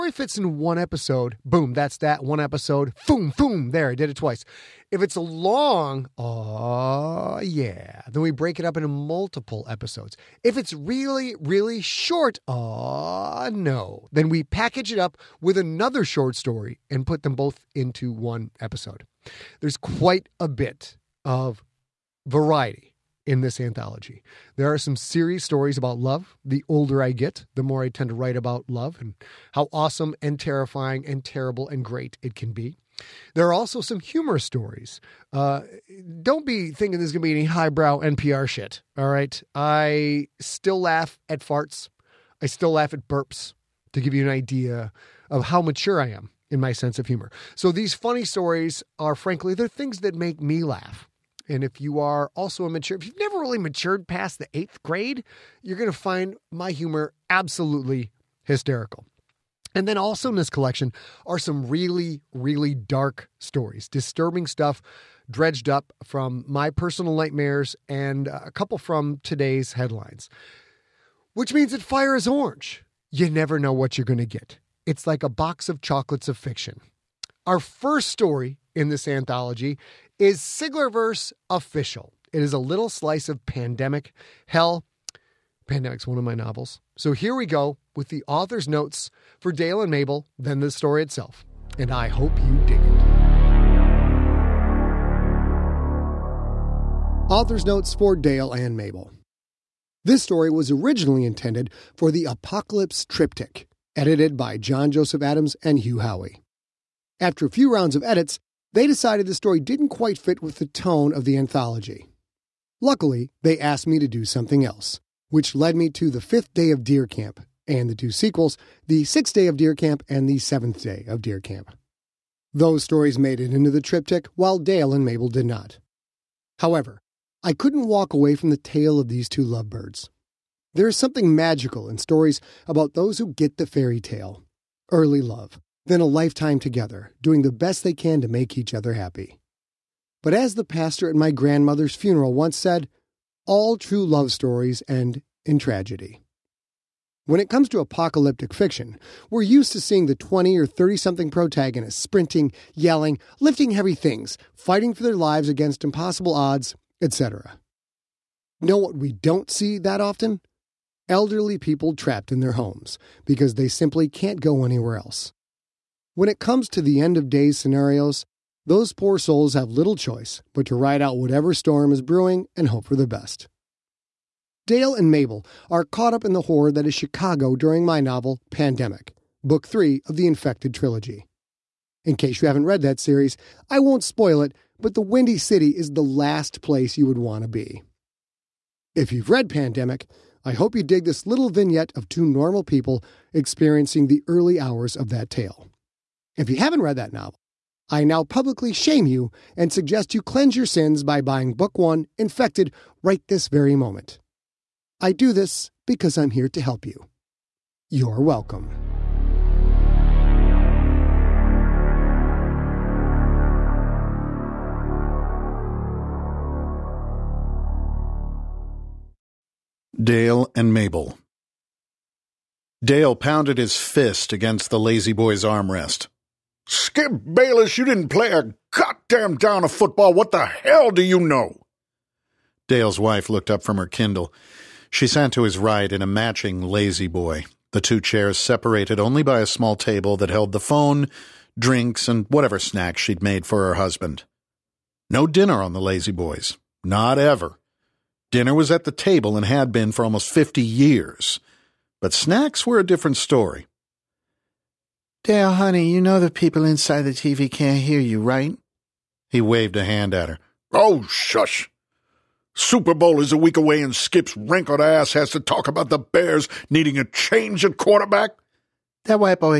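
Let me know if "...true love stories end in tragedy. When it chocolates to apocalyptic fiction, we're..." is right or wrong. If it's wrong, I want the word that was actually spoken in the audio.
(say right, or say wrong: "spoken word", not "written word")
wrong: "comes", not "chocolates".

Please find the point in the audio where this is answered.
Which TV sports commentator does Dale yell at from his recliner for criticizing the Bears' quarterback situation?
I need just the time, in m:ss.
3:46.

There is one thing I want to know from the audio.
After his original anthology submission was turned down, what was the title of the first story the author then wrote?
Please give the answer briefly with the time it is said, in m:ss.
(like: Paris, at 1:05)
The Fifth Day of Deer Camp, at 1:56.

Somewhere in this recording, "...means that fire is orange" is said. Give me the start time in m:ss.
1:11.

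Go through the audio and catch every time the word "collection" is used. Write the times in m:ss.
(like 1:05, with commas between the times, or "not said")
1:00.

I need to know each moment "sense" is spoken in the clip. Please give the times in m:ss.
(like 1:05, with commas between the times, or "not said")
0:46.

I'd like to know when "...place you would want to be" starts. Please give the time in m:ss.
3:06.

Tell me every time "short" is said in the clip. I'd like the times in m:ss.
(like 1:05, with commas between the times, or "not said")
0:11, 0:16.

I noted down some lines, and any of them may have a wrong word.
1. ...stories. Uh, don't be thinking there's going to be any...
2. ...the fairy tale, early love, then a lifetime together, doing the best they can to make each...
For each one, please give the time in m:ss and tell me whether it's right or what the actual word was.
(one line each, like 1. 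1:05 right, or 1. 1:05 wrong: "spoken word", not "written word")
1. 0:34 right
2. 2:13 right.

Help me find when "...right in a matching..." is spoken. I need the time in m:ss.
3:55.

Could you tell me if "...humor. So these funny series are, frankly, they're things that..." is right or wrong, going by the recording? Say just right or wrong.
wrong.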